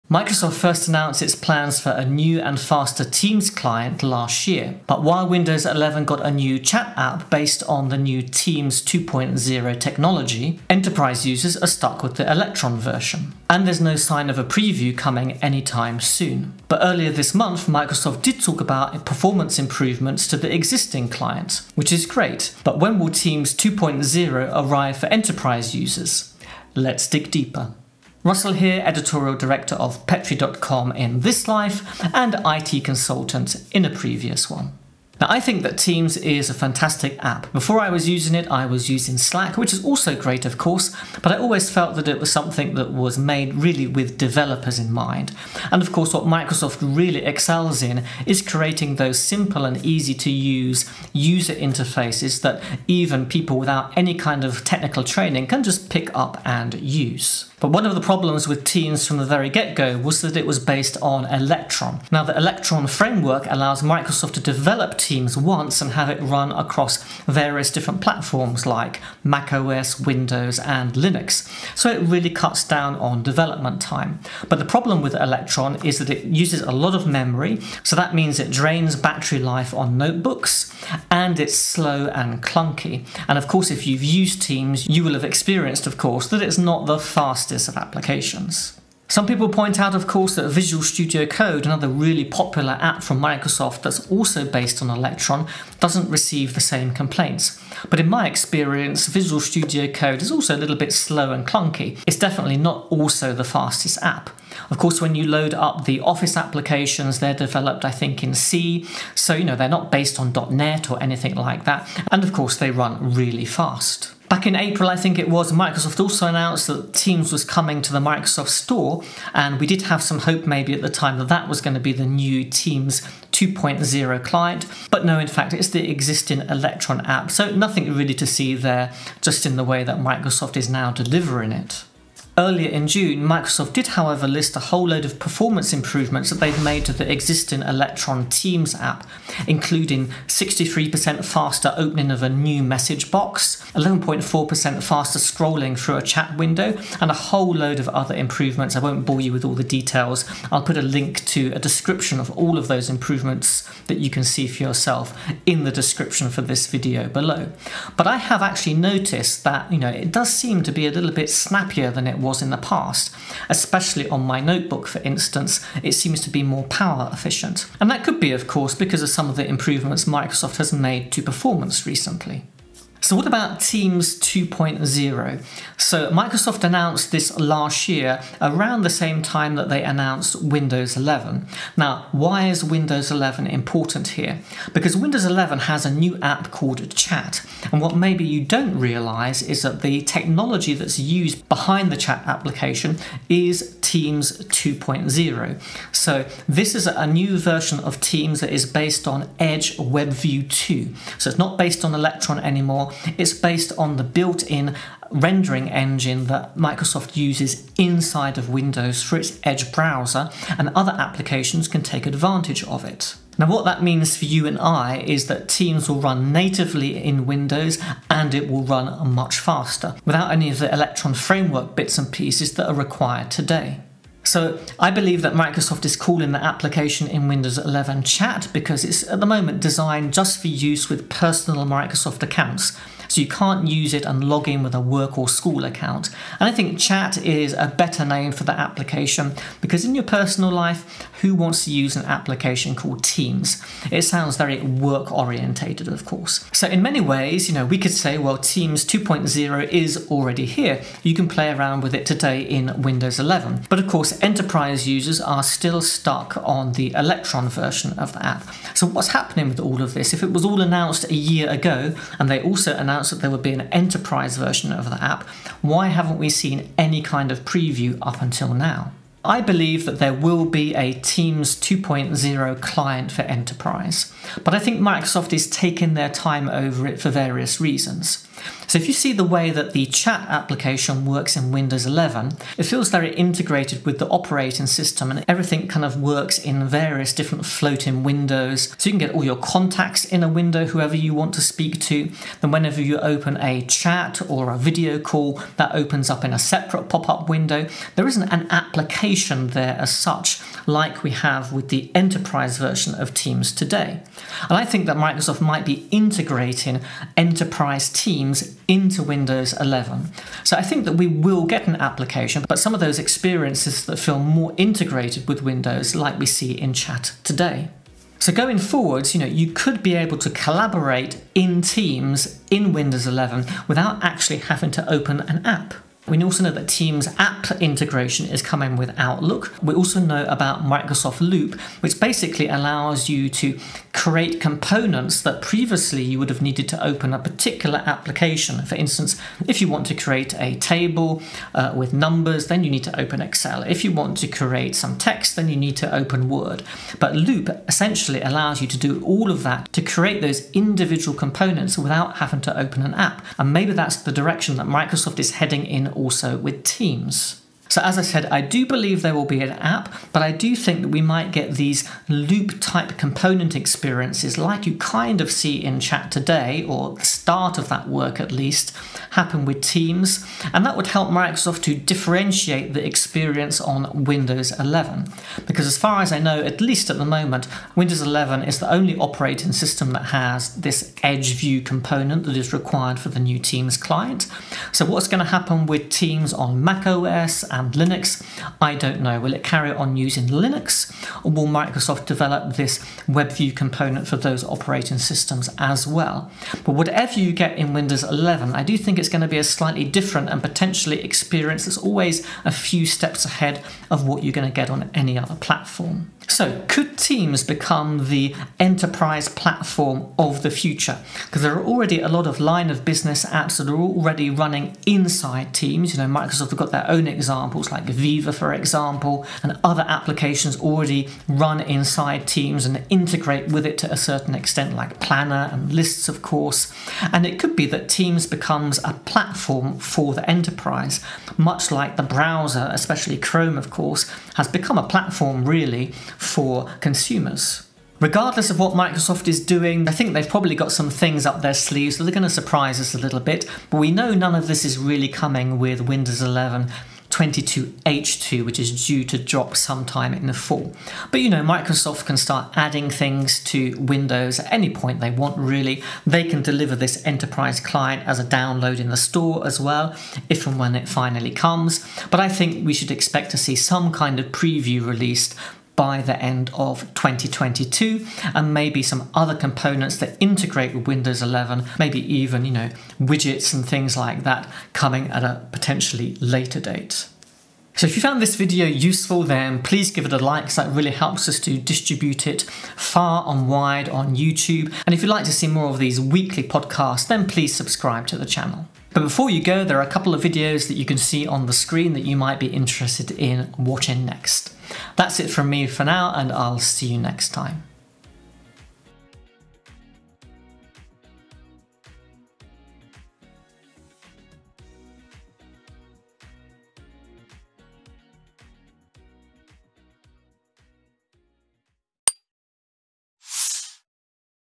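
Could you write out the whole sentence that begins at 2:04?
But no, in fact, it's the existing Electron app.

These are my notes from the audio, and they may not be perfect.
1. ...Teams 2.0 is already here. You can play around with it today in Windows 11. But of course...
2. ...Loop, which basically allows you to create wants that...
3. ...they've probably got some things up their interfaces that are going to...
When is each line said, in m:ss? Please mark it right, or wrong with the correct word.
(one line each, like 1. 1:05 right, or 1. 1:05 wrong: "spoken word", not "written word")
1. 4:08 right
2. 5:31 wrong: "components", not "wants"
3. 7:20 wrong: "sleeves", not "interfaces".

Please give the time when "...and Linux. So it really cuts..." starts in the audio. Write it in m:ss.
1:10.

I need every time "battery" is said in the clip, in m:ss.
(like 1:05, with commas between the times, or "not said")
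1:18.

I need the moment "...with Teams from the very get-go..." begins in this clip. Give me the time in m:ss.
0:58.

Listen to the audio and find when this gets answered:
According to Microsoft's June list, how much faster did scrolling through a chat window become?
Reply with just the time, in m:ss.
2:23.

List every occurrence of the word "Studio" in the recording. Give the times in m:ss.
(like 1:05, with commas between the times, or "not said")
1:30, 1:39.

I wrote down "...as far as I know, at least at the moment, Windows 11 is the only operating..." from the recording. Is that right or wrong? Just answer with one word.
right.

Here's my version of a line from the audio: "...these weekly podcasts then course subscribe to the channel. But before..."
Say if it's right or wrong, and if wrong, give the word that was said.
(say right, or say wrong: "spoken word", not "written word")
wrong: "please", not "course".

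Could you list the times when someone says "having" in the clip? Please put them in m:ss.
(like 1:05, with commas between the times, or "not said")
5:24, 5:52.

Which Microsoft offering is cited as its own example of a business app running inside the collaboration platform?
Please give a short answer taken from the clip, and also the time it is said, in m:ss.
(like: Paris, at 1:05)
Viva, at 6:57.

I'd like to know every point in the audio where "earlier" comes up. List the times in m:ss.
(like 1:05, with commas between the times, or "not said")
0:16, 2:12.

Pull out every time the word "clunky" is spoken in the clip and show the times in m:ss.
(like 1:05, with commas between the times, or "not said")
1:22, 1:41.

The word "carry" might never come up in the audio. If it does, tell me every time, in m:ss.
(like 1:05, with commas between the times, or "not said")
6:29.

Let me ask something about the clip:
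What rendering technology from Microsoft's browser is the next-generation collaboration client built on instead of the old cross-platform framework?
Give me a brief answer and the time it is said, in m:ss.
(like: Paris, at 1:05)
Edge WebView 2, at 3:19.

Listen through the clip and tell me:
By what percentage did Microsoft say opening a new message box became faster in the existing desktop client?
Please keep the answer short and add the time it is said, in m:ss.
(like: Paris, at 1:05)
63%, at 2:20.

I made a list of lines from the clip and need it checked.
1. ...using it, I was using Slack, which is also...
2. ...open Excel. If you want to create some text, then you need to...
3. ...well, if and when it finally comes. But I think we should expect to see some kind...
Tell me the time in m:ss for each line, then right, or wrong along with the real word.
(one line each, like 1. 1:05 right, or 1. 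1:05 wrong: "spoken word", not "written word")
1. 0:38 right
2. 5:42 right
3. 7:39 right.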